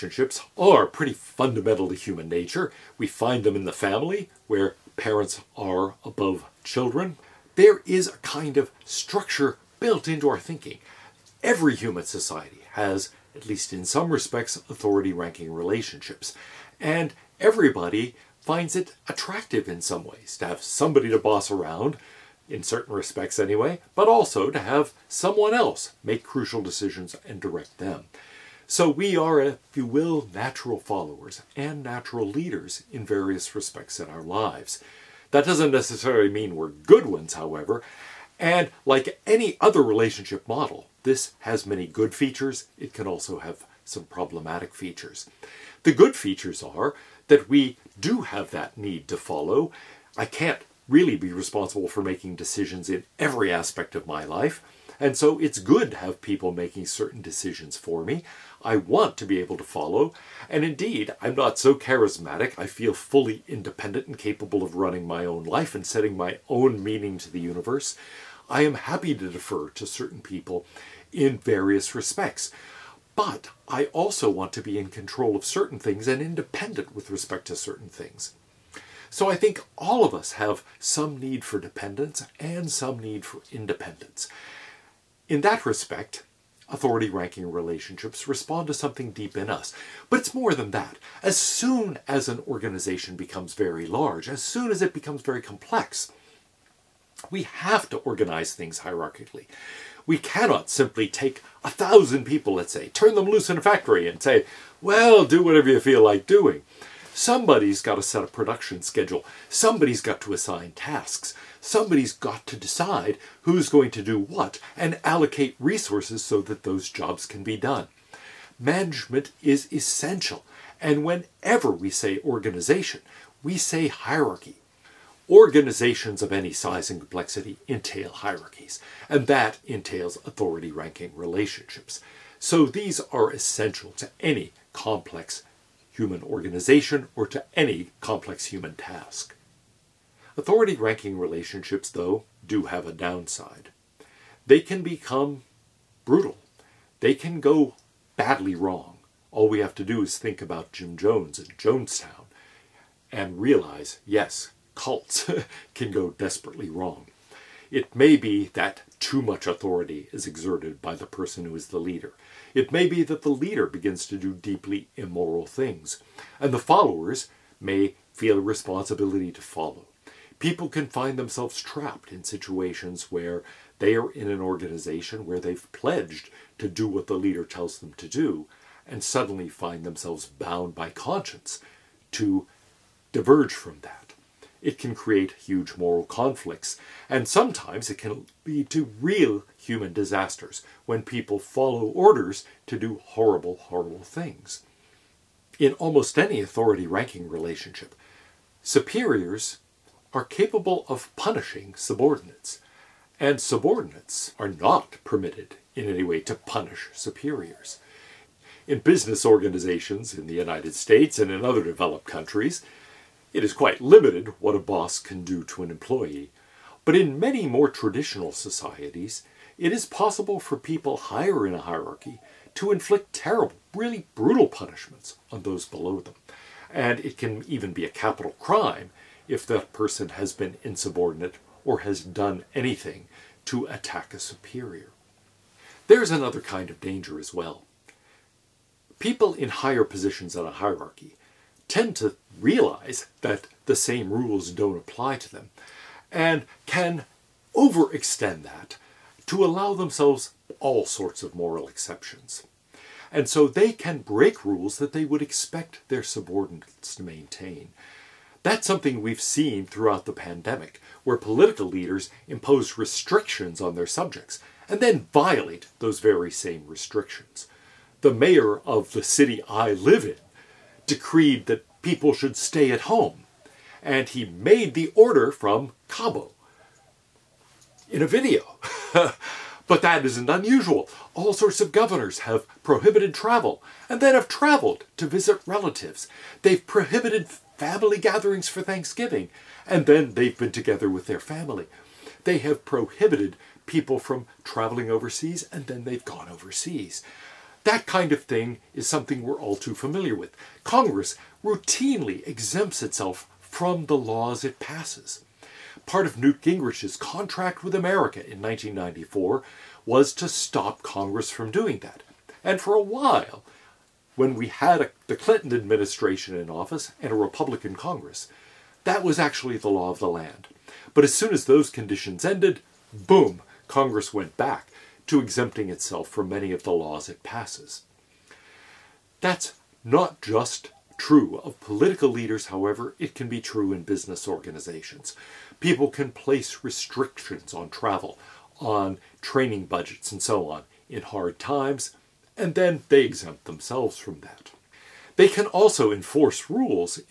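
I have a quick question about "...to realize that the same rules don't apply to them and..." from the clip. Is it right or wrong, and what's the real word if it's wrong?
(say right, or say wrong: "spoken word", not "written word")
right.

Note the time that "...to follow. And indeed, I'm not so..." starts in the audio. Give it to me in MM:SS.
00:59.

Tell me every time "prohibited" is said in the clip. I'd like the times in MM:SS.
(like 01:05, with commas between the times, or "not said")
04:42, 04:46, 04:52.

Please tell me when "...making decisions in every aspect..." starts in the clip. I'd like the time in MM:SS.
00:52.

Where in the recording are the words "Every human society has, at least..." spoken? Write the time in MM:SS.
00:11.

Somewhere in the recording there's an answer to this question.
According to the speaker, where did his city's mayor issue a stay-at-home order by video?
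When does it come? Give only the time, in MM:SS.
04:35.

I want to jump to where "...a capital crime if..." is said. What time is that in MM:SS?
03:47.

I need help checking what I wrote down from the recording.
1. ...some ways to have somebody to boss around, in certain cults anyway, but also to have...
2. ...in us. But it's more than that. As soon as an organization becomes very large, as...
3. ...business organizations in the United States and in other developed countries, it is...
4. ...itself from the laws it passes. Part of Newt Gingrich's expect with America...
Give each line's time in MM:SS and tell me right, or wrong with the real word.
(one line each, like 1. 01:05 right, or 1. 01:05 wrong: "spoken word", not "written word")
1. 00:19 wrong: "respects", not "cults"
2. 01:29 right
3. 03:28 right
4. 05:02 wrong: "contract", not "expect".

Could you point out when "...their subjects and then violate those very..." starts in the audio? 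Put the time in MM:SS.
04:23.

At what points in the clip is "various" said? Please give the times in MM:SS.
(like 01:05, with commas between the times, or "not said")
00:33, 01:11.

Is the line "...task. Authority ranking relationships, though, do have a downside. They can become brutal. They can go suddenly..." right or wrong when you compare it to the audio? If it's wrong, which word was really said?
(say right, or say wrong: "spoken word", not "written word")
wrong: "badly", not "suddenly".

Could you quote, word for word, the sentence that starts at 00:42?
It can also have some problematic features.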